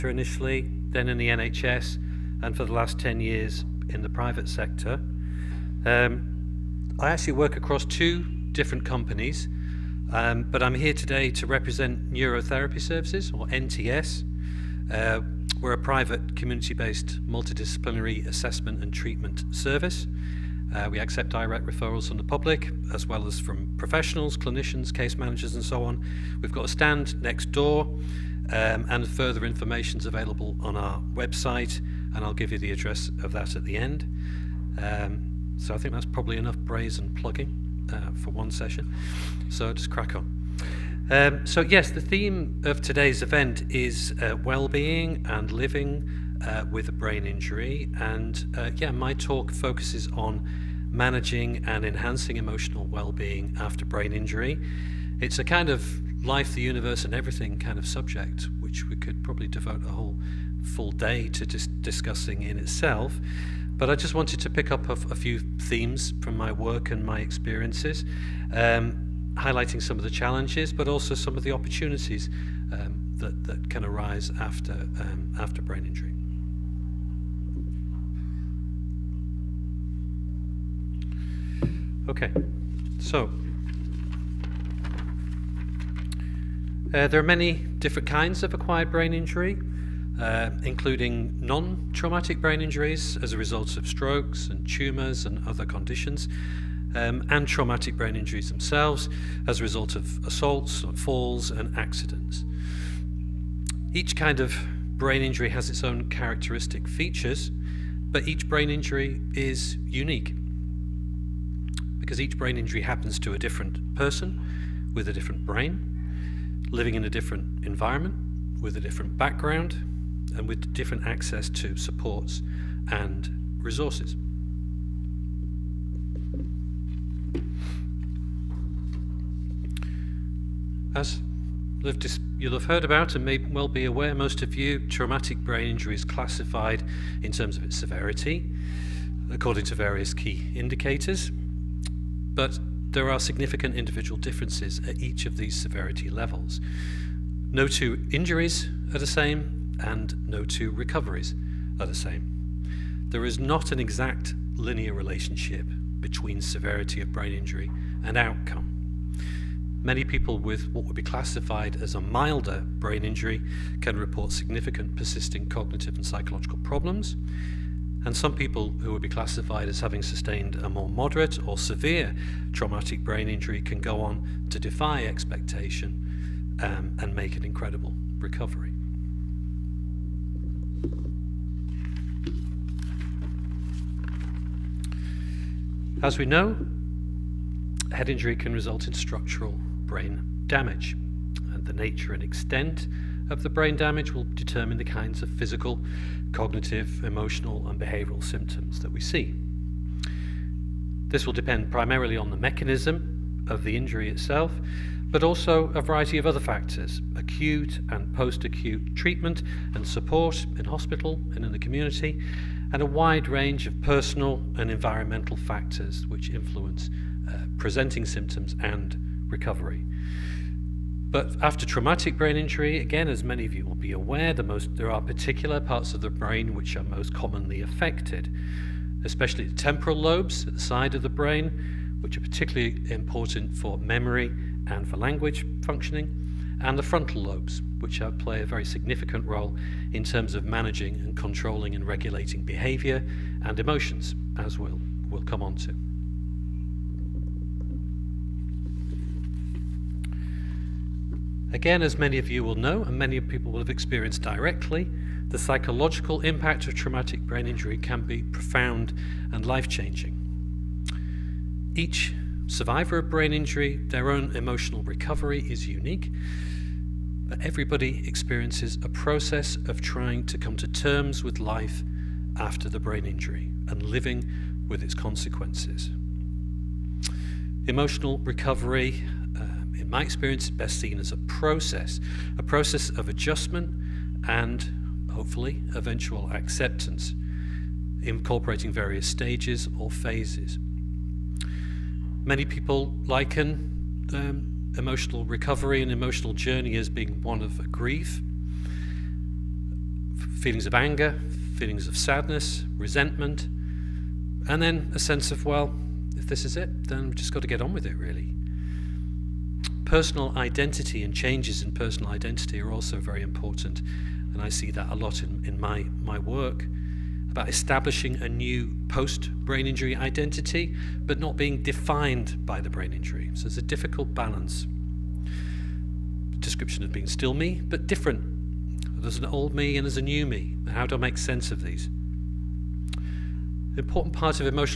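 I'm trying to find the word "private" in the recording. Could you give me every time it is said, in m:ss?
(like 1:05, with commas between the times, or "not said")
0:04, 0:15.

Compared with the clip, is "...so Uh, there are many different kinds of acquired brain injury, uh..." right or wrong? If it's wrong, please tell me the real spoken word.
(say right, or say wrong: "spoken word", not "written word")
right.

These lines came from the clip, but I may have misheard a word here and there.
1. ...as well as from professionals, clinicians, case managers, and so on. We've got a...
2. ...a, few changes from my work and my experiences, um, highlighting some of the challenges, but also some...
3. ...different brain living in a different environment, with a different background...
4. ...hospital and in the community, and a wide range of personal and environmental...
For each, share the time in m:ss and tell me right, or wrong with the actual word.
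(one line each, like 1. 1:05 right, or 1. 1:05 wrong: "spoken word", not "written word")
1. 0:22 right
2. 1:04 wrong: "themes", not "changes"
3. 1:55 right
4. 3:30 right.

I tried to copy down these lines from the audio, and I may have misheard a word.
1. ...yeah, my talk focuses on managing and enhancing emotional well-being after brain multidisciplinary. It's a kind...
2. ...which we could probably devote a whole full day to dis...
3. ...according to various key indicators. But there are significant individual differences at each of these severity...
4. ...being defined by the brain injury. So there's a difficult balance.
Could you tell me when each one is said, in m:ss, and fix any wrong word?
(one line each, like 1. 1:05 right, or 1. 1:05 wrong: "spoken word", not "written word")
1. 0:48 wrong: "injury", not "multidisciplinary"
2. 0:58 right
3. 2:19 right
4. 5:21 right.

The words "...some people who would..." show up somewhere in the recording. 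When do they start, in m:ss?
2:48.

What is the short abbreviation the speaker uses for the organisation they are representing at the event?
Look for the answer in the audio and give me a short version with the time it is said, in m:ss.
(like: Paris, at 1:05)
NTS, at 0:13.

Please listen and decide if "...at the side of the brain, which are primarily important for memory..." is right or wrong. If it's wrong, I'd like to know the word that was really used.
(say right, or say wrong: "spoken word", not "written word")
wrong: "particularly", not "primarily".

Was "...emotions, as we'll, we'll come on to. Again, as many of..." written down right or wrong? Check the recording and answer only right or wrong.
right.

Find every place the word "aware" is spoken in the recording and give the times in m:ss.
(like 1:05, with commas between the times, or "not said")
2:13, 3:43.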